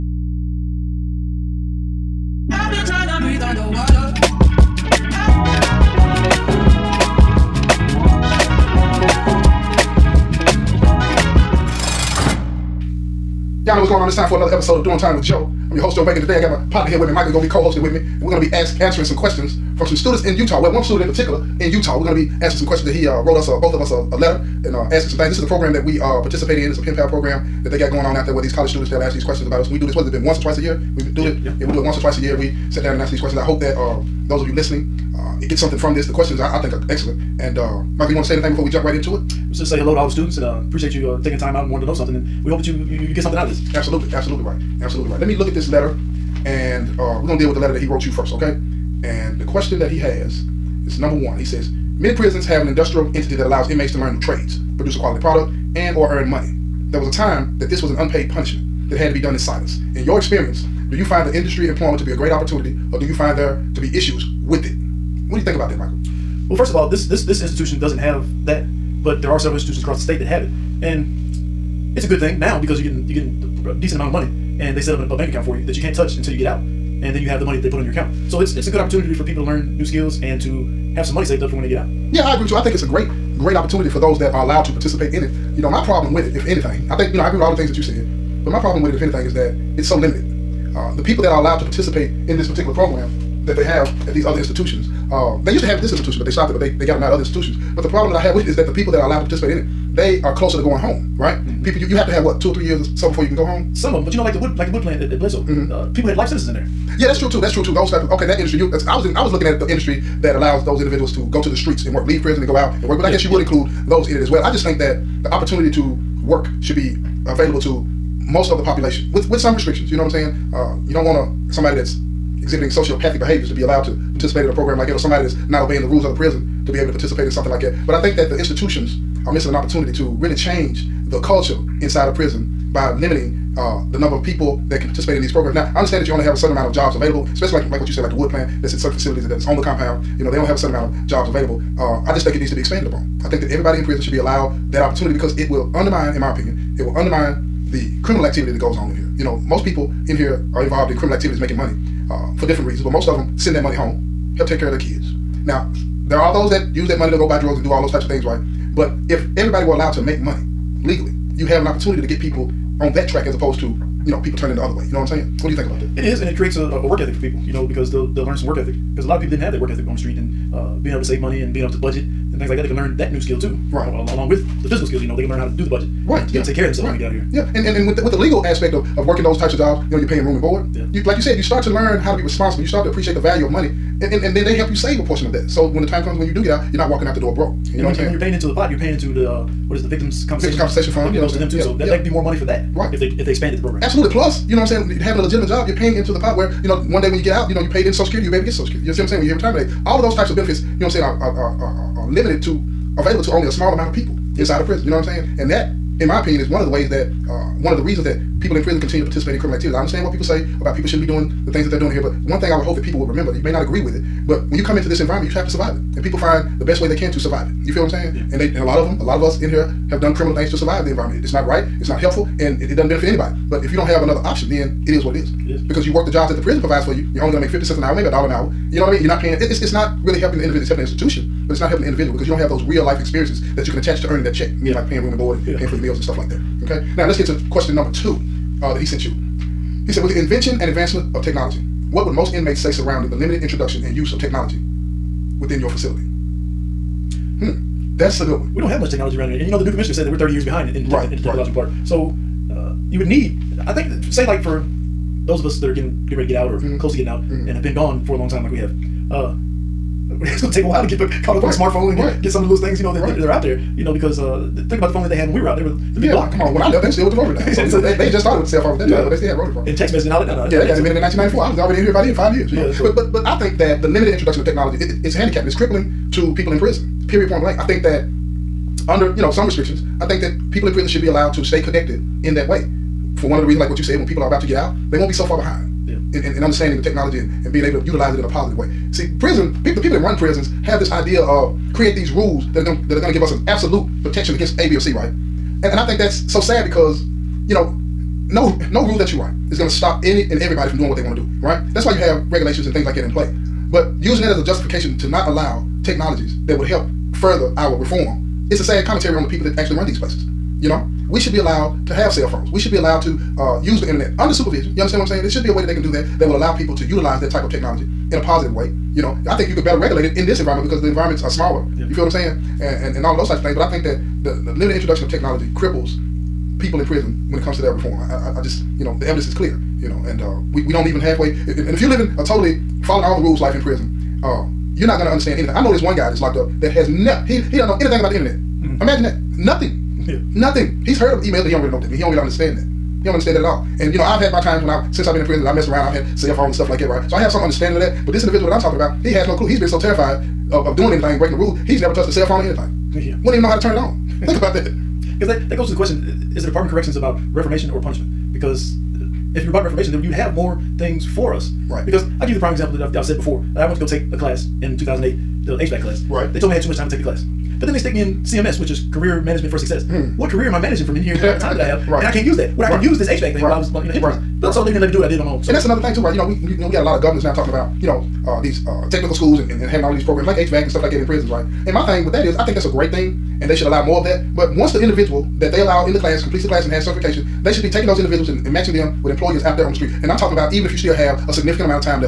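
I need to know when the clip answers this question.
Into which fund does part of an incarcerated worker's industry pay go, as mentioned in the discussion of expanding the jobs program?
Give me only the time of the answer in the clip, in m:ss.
3:10.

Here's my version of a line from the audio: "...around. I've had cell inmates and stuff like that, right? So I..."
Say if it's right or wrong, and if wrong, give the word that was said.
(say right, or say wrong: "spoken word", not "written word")
wrong: "phones", not "inmates".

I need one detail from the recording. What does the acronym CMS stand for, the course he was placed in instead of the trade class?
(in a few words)
Career Management for Success.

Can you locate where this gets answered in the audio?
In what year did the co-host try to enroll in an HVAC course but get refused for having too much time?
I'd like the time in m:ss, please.
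6:04.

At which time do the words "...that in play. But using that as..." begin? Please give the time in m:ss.
5:02.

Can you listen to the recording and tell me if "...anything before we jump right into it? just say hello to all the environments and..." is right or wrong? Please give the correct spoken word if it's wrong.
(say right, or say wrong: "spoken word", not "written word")
wrong: "students", not "environments".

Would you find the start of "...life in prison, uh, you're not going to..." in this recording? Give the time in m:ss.
5:33.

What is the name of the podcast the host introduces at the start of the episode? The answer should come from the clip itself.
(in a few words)
Doing Time with Joe.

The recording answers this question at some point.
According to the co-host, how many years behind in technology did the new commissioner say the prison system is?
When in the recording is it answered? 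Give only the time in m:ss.
4:10.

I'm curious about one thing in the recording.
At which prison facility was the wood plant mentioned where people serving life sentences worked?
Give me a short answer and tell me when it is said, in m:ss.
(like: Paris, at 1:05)
Bledsoe, at 1:45.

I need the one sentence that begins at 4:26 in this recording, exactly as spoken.
Come on, when I left, they were still with the rotary dial.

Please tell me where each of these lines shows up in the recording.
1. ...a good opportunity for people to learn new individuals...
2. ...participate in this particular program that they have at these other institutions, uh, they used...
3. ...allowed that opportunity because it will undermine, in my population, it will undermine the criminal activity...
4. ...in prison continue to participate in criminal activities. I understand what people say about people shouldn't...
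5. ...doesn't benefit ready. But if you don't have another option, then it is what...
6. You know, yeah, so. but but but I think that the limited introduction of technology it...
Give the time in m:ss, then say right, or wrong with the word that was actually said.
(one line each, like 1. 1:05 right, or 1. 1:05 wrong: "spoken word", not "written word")
1. 1:18 wrong: "skills", not "individuals"
2. 1:31 right
3. 2:24 wrong: "opinion", not "population"
4. 3:28 right
5. 3:42 wrong: "anybody", not "ready"
6. 4:32 right.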